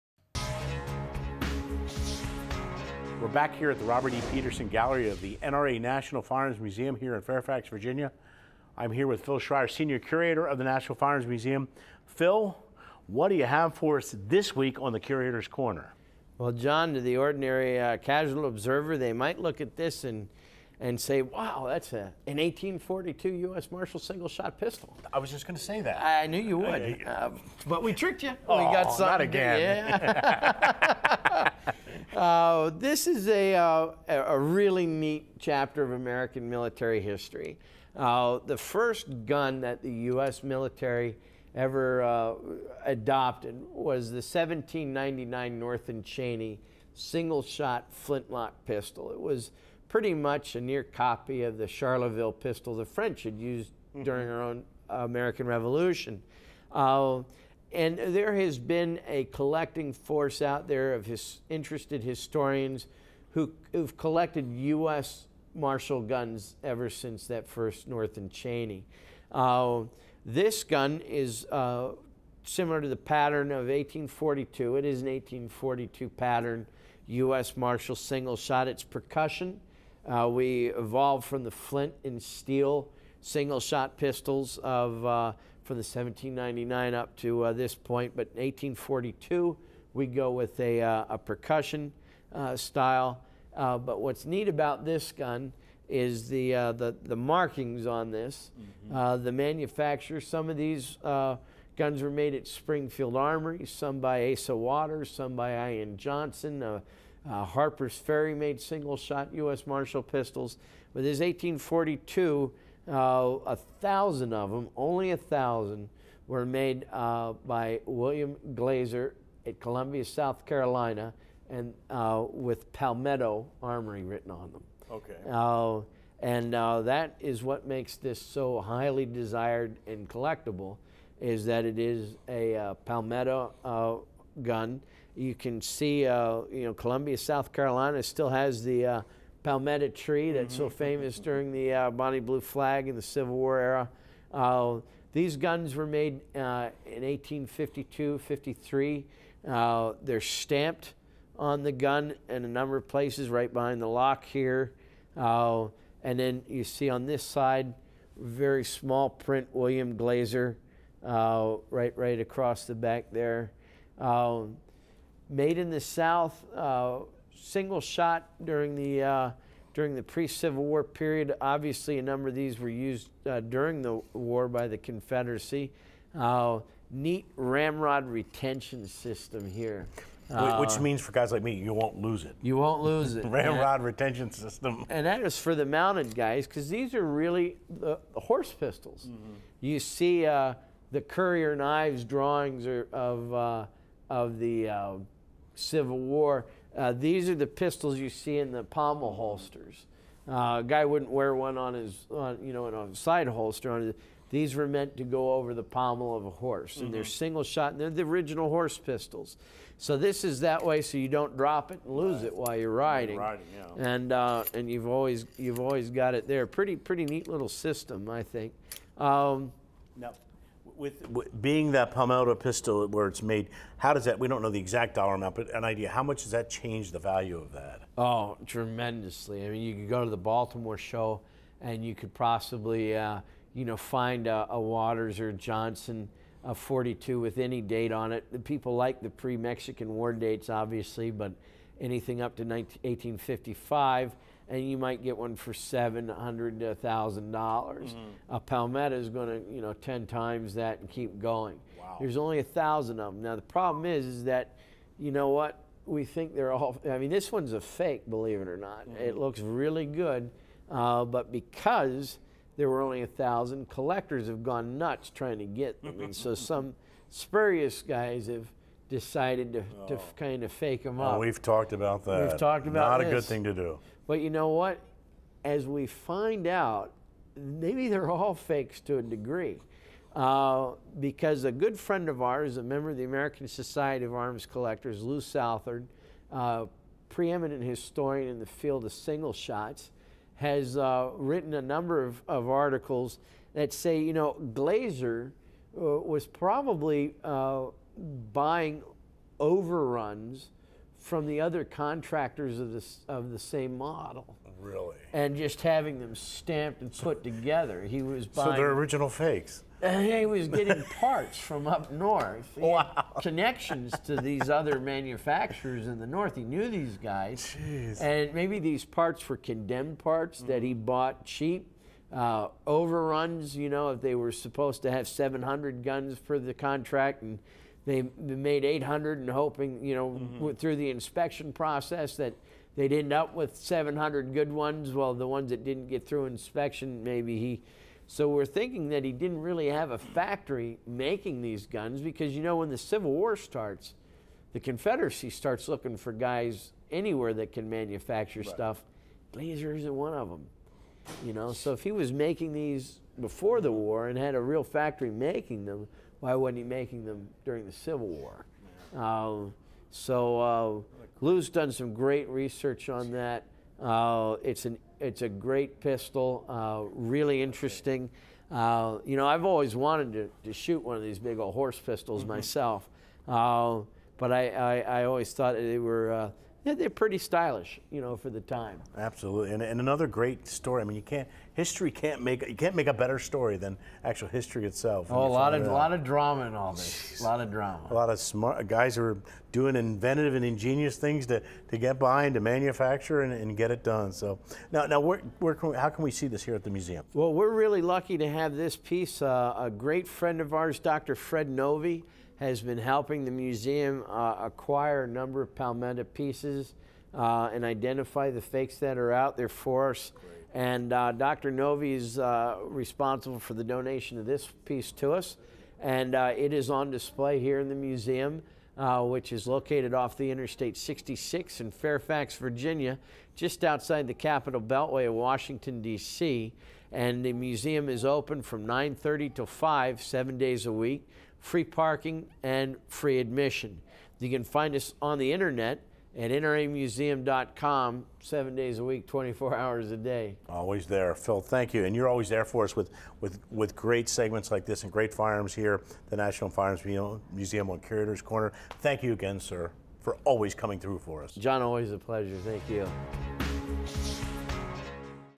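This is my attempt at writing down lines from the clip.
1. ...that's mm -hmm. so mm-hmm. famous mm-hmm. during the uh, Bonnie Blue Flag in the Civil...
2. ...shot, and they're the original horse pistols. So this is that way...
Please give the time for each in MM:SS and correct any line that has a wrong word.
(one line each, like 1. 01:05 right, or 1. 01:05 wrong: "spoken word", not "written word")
1. 02:20 right
2. 03:27 right.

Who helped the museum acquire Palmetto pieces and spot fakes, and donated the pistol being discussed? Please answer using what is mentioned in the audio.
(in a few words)
Dr. Fred Novi.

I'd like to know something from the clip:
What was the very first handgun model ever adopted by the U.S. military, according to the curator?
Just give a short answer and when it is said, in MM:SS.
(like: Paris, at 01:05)
1799 North and Cheney, at 00:44.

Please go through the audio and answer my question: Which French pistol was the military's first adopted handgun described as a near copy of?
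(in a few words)
Charleville pistol.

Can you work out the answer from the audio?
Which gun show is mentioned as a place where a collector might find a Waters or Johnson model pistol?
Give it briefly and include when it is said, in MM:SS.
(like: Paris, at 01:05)
Baltimore show, at 03:50.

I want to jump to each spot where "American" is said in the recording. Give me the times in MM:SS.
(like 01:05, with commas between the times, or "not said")
00:35, 00:54, 04:43.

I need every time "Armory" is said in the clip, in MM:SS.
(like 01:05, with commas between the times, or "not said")
01:43, 02:03.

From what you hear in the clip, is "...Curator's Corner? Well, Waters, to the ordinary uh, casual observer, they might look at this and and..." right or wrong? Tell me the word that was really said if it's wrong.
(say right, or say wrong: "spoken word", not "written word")
wrong: "John", not "Waters".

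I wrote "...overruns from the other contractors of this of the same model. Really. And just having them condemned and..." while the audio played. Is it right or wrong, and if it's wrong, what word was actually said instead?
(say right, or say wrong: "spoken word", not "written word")
wrong: "stamped", not "condemned".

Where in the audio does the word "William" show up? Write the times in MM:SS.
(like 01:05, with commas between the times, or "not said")
01:57, 02:39.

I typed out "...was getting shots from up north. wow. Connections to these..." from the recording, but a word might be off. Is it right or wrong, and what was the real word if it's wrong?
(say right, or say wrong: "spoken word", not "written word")
wrong: "parts", not "shots".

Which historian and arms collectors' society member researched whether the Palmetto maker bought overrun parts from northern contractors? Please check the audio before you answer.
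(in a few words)
Lou Southard.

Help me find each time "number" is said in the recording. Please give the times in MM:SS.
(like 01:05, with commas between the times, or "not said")
02:32, 02:52, 04:51, 06:45.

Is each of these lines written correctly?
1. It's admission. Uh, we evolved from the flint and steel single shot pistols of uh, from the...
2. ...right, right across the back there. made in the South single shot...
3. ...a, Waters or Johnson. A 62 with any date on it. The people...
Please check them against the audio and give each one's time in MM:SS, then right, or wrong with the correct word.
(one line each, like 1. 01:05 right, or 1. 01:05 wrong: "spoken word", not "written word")
1. 01:18 wrong: "percussion", not "admission"
2. 02:41 right
3. 03:54 wrong: "42", not "62".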